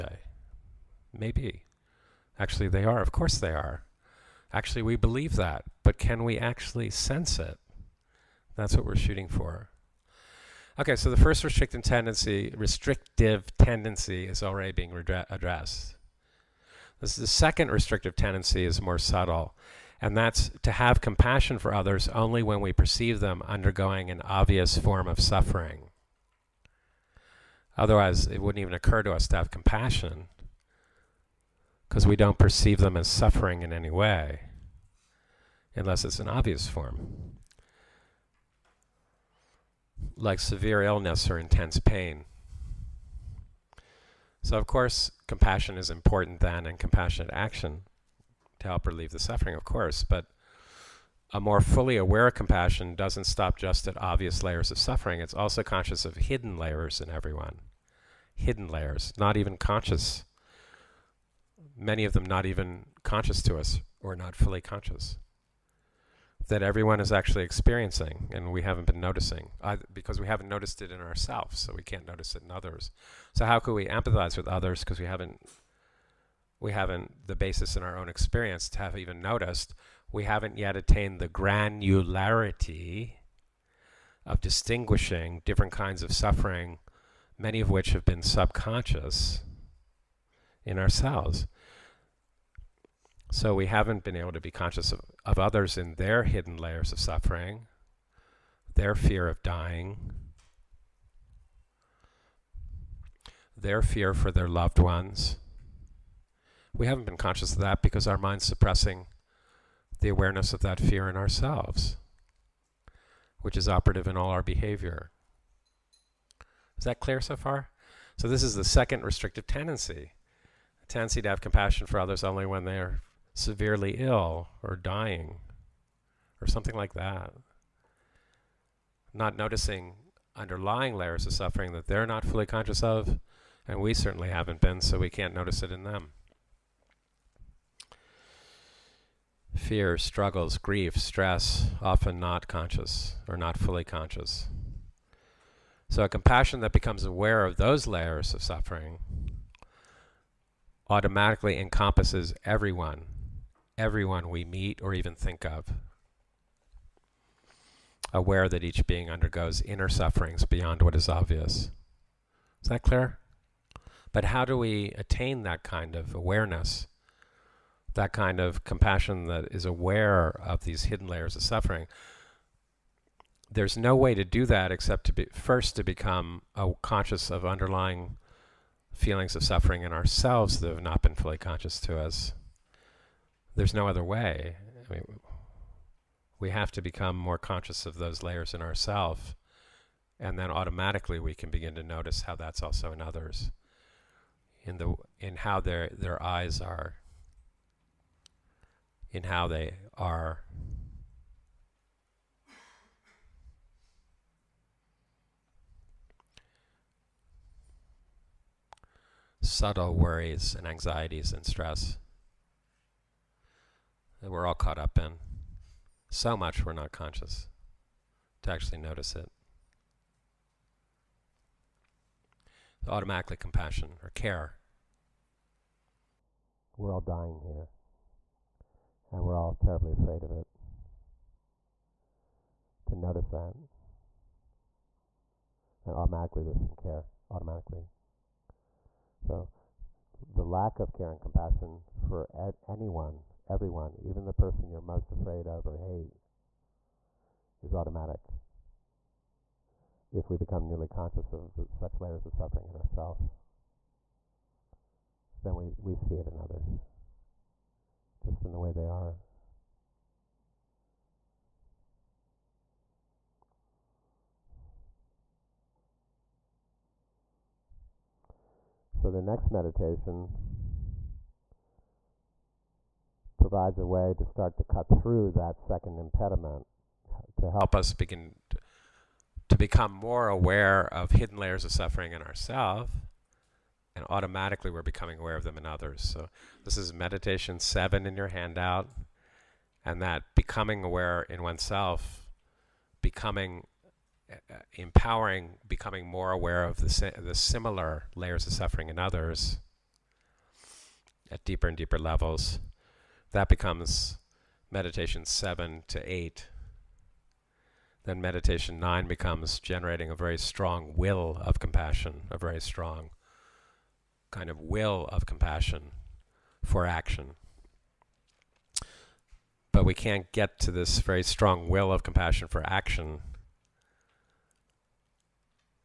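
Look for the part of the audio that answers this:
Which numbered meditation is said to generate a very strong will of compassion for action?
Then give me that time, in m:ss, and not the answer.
5:08.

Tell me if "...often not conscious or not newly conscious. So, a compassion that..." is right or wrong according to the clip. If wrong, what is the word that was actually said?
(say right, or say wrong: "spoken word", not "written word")
wrong: "fully", not "newly".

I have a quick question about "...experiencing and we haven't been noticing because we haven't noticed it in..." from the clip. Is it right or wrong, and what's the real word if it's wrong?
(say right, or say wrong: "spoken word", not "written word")
right.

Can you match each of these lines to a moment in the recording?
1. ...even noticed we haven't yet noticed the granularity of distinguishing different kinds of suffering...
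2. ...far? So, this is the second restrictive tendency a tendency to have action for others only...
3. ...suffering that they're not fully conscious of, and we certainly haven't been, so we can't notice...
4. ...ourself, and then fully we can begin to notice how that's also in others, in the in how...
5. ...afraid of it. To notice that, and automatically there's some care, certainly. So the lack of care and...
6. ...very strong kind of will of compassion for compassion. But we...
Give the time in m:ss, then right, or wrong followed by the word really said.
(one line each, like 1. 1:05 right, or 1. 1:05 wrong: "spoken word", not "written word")
1. 1:18 wrong: "attained", not "noticed"
2. 1:57 wrong: "compassion", not "action"
3. 2:11 right
4. 3:08 wrong: "automatically", not "fully"
5. 3:49 wrong: "automatically", not "certainly"
6. 5:12 wrong: "action", not "compassion".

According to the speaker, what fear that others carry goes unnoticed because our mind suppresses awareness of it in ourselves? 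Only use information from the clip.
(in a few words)
fear of dying.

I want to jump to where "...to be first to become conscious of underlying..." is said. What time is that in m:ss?
2:55.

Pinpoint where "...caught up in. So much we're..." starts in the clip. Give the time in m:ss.
3:34.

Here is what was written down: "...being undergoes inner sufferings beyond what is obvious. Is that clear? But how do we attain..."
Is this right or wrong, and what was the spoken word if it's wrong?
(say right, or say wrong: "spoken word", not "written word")
right.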